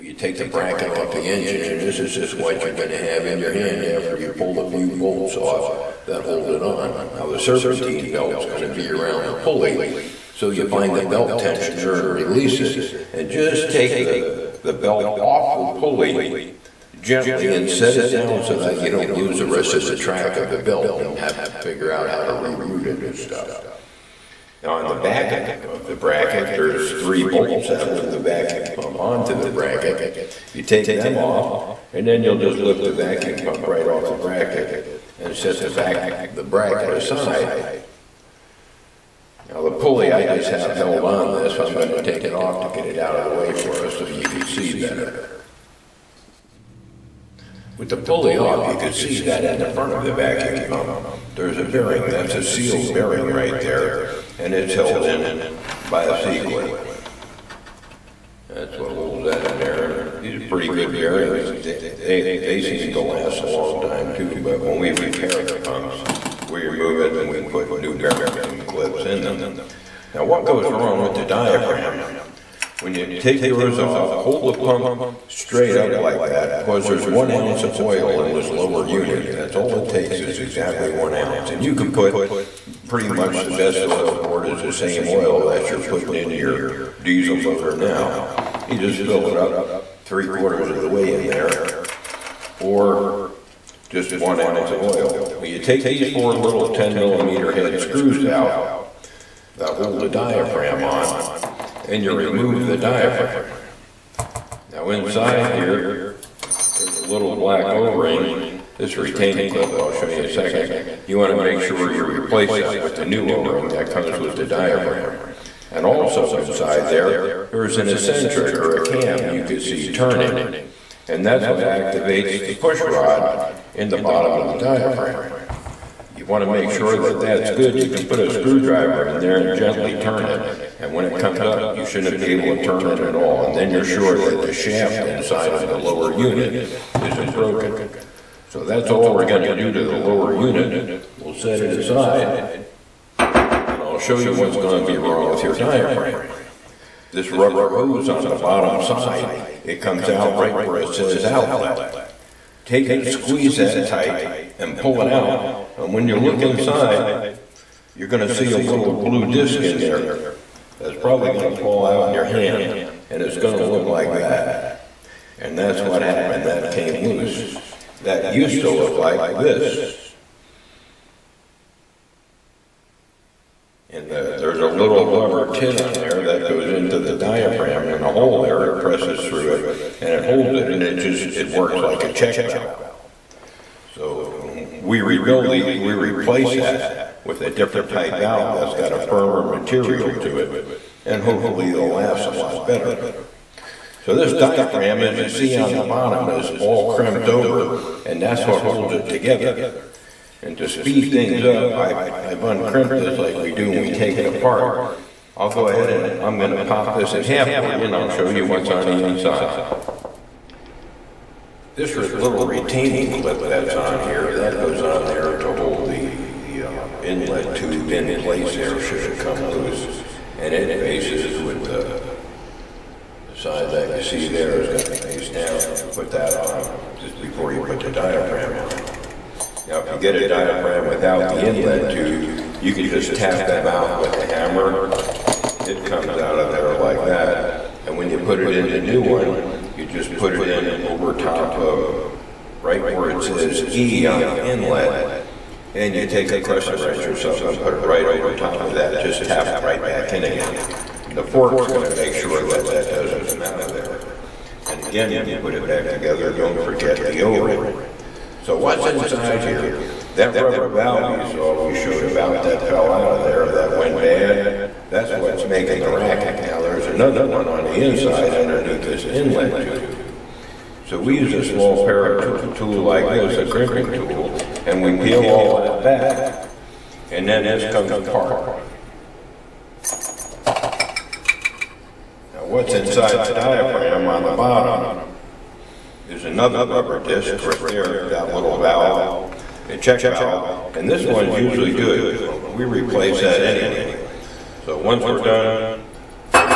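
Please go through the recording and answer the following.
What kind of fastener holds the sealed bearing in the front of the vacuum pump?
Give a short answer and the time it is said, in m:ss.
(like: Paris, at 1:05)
C-clip, at 0:56.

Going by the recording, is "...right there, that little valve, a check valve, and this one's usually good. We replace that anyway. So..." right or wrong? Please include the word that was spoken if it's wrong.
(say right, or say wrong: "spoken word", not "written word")
right.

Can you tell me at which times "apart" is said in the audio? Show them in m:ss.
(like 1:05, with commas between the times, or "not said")
3:24, 4:37.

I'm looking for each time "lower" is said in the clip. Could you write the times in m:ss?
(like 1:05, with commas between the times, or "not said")
1:18, 2:15, 2:19.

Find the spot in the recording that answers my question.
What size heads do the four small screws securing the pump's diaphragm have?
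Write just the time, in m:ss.
1:36.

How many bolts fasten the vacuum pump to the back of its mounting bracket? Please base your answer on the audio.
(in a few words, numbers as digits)
3.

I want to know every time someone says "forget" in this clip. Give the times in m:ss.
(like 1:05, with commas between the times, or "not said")
4:16.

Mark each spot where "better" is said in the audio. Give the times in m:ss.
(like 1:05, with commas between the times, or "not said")
0:44, 3:12.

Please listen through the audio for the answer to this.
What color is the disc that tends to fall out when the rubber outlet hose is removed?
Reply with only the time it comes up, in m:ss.
2:38.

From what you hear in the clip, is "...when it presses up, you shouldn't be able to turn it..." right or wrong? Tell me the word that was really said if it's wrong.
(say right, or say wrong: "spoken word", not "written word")
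wrong: "comes", not "presses".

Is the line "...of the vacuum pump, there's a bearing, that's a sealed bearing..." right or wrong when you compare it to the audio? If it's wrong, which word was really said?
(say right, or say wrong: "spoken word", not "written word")
right.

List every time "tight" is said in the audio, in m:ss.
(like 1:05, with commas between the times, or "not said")
2:33.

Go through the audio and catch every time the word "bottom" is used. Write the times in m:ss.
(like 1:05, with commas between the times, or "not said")
2:03, 2:28, 3:15, 4:44.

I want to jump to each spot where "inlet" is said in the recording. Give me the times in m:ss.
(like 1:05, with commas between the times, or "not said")
3:37, 3:51, 4:04, 4:29.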